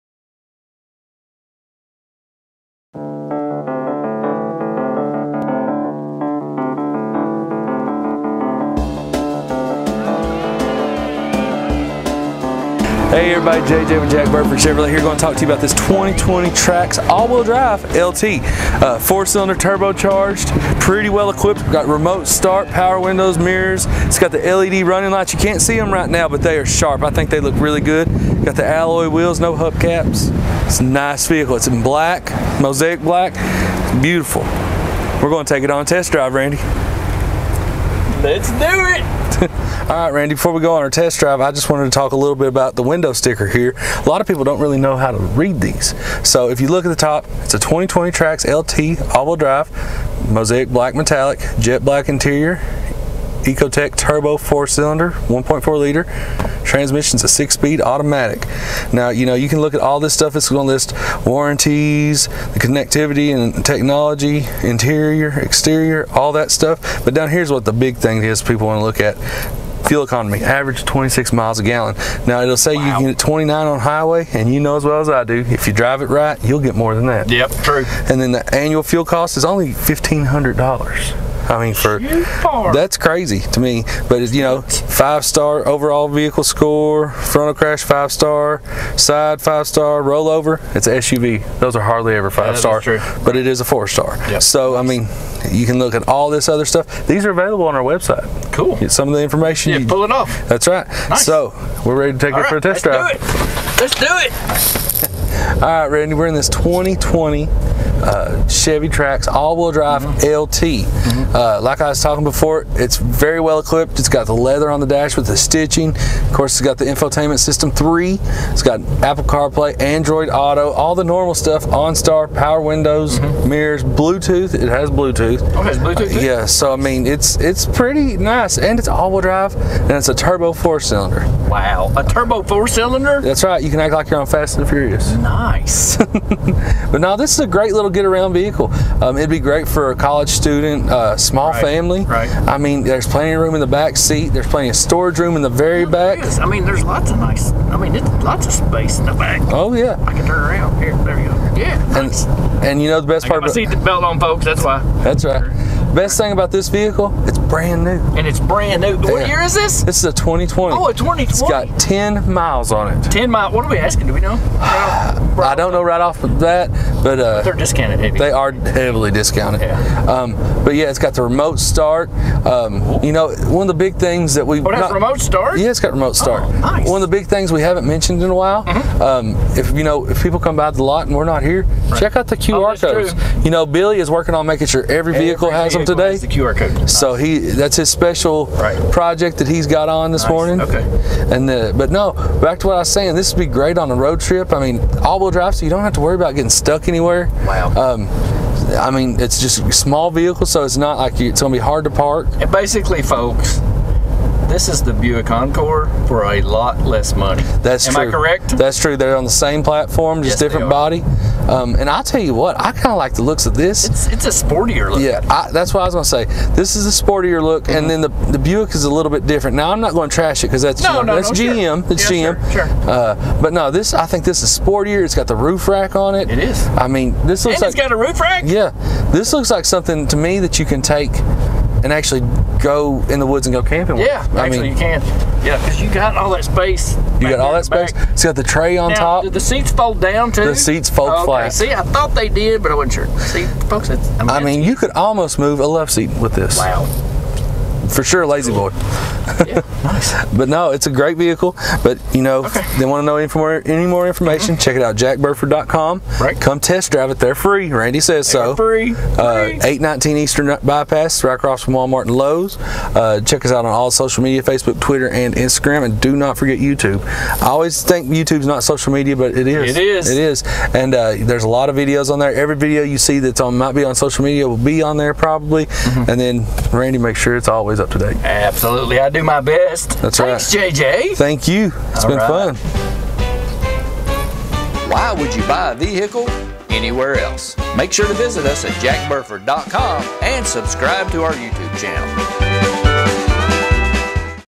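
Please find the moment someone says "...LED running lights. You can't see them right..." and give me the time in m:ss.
0:24.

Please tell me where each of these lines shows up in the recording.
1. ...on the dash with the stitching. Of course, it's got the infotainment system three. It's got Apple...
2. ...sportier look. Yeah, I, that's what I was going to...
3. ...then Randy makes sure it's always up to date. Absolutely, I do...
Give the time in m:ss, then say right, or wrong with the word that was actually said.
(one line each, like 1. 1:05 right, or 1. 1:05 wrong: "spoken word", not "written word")
1. 1:54 right
2. 3:34 right
3. 4:36 right.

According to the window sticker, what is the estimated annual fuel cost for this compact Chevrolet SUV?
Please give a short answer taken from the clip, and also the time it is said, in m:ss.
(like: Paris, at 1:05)
$1500, at 1:19.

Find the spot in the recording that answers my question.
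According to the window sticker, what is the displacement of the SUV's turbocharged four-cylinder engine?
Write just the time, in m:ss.
0:55.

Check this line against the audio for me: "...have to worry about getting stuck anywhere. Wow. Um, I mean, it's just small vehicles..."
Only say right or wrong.
right.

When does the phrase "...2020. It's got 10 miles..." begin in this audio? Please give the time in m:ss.
2:40.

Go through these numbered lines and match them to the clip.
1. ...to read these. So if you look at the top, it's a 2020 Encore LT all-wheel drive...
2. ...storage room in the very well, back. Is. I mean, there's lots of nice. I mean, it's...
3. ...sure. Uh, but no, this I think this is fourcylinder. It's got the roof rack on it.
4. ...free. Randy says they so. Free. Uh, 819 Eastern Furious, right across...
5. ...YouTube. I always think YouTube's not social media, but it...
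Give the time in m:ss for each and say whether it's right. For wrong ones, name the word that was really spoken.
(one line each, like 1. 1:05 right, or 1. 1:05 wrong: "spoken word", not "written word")
1. 0:45 wrong: "Trax", not "Encore"
2. 2:24 right
3. 3:42 wrong: "sportier", not "fourcylinder"
4. 4:17 wrong: "Bypass", not "Furious"
5. 4:26 right.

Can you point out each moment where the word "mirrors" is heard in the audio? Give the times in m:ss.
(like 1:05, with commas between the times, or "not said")
0:23, 2:03.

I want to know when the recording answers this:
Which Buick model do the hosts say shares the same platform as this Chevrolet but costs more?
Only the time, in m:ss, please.
3:24.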